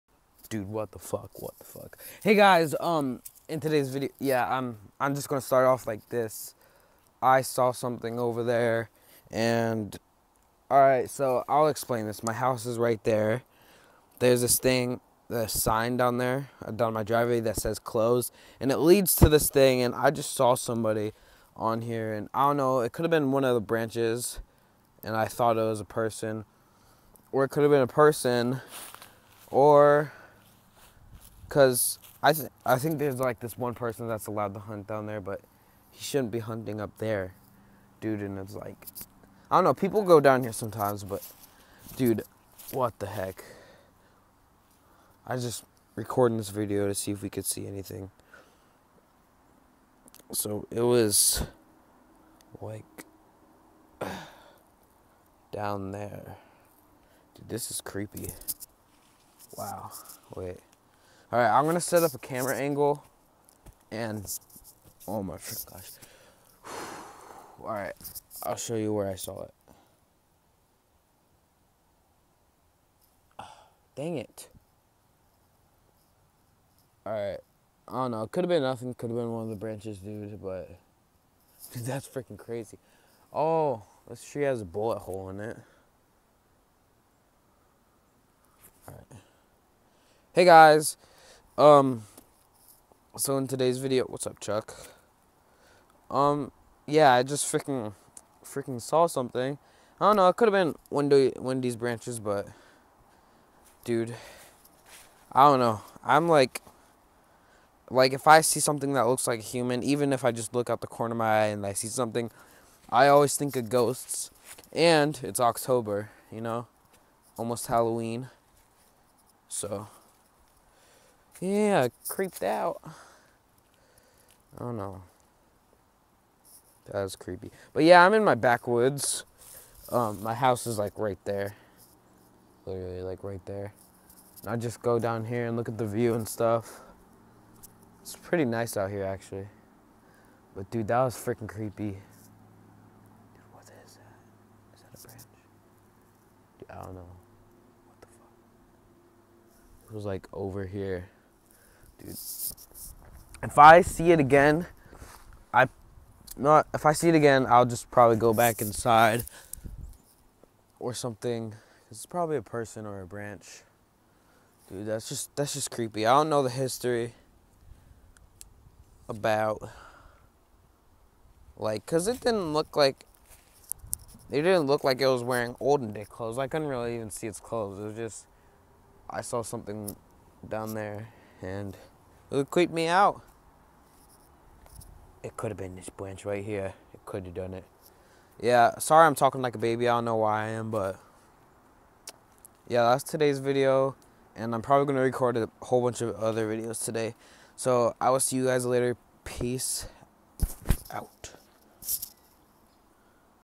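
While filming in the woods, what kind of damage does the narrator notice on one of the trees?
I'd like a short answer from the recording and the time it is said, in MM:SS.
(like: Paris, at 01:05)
A bullet hole, at 01:24.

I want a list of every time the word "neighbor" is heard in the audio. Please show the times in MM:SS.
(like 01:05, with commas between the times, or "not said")
not said.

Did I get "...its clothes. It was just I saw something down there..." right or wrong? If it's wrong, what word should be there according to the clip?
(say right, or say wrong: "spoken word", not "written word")
right.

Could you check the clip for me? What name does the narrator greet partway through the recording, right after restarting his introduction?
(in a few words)
Chuck.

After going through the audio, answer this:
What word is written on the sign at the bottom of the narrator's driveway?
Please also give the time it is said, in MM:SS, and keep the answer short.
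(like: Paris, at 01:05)
Closed, at 00:17.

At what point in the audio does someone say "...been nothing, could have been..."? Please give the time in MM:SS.
01:18.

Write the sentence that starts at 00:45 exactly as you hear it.
I just recording this video to see if we could see anything.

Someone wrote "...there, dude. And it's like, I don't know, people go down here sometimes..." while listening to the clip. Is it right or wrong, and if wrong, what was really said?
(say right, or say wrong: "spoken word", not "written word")
right.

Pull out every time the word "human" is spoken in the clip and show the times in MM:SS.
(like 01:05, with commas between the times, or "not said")
01:49.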